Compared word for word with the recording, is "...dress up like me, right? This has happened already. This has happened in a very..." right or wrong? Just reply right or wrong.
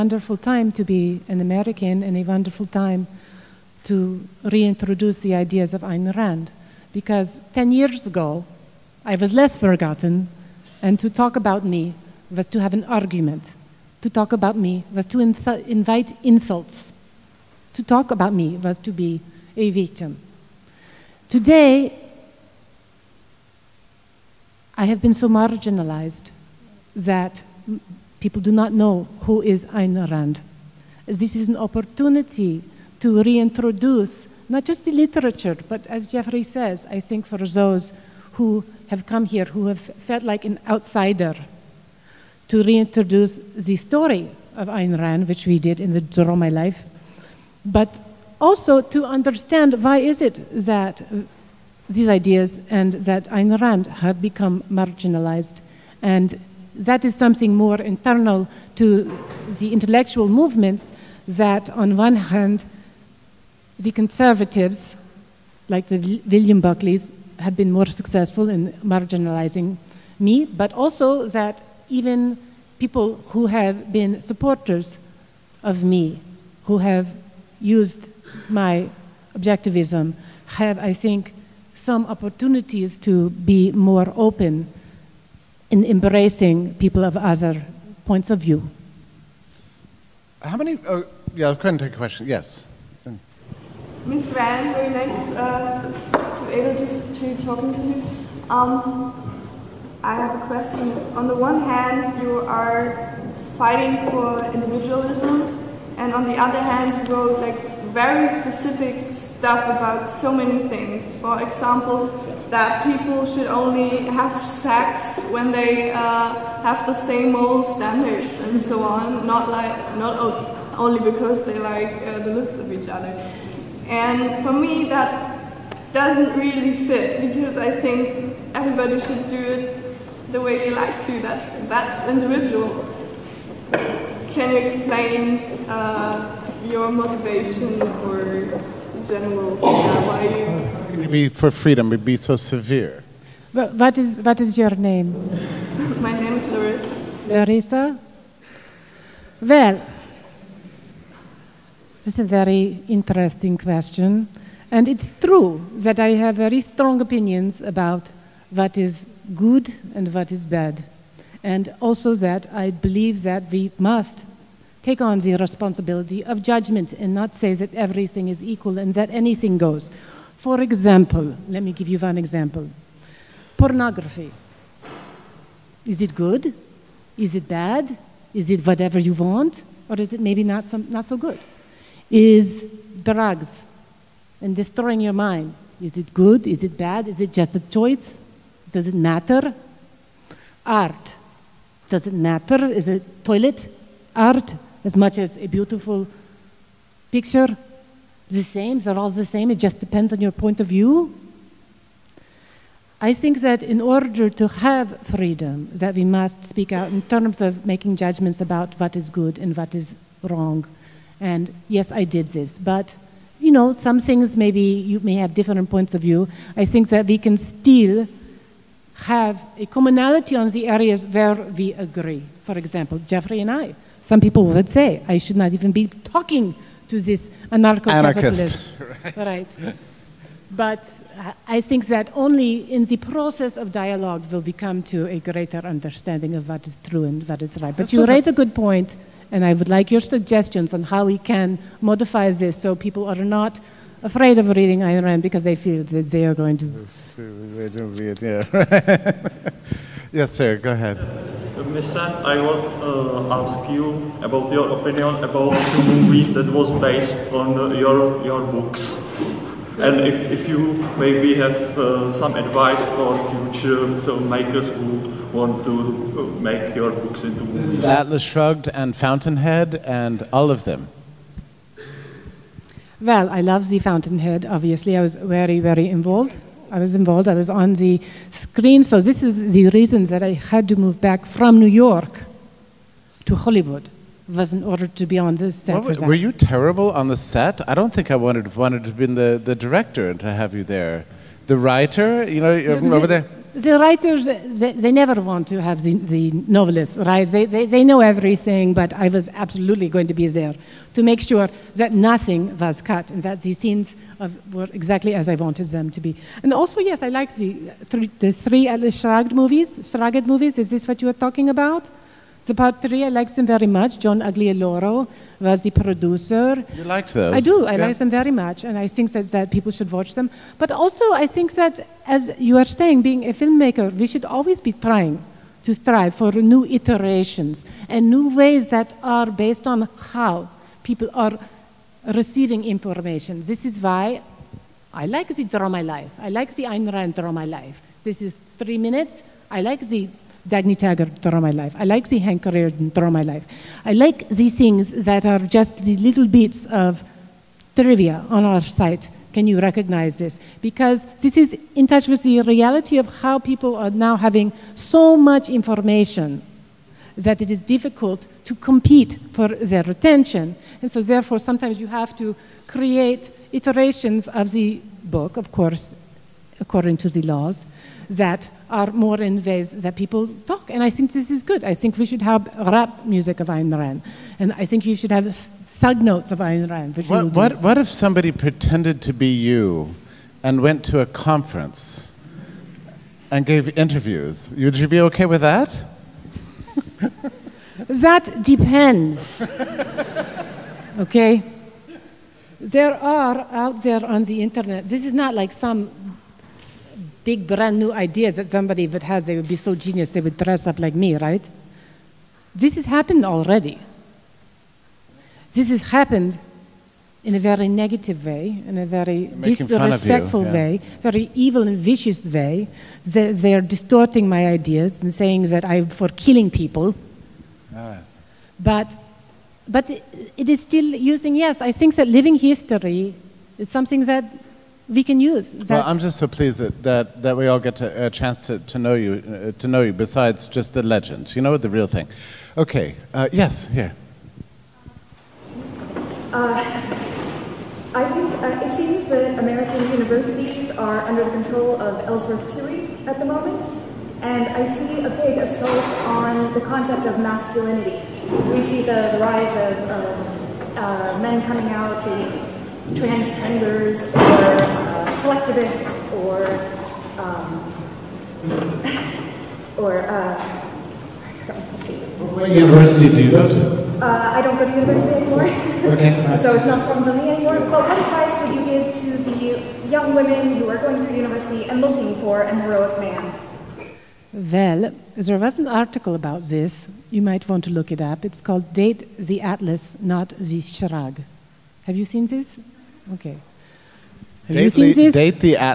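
right.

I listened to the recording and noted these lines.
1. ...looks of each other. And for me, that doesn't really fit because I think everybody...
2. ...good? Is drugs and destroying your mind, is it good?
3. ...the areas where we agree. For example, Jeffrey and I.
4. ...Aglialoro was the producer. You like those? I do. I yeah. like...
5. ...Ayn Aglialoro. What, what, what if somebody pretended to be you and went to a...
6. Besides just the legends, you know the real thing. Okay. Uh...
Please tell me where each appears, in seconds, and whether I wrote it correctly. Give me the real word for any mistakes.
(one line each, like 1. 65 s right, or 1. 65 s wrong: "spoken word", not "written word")
1. 122 s right
2. 181 s right
3. 220 s right
4. 314 s right
5. 376 s wrong: "Rand", not "Aglialoro"
6. 429 s right.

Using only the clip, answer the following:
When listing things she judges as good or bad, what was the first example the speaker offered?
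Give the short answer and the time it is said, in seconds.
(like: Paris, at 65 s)
Pornography, at 173 s.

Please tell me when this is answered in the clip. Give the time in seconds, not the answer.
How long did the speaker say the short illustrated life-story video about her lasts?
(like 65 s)
338 s.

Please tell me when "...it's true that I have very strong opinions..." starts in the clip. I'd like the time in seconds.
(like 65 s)
154 s.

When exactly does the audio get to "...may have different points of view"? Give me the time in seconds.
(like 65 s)
214 s.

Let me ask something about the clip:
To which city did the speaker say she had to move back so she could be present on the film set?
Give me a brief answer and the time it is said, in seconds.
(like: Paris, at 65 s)
Hollywood, at 283 s.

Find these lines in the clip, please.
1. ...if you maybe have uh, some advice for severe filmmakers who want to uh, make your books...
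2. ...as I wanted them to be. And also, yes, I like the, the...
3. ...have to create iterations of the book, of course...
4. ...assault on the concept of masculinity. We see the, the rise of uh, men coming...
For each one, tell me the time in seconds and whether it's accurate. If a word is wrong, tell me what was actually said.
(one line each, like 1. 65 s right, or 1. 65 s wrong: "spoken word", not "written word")
1. 260 s wrong: "future", not "severe"
2. 305 s right
3. 361 s right
4. 445 s right.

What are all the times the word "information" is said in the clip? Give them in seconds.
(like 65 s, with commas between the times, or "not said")
332 s, 355 s.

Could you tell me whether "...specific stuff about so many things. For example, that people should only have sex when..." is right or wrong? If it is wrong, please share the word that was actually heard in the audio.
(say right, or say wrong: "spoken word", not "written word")
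right.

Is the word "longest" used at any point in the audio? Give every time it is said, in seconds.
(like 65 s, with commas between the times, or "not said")
not said.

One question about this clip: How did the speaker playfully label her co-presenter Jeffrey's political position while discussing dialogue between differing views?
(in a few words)
Anarcho-capitalist.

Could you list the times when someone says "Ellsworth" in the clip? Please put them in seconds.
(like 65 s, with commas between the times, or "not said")
442 s.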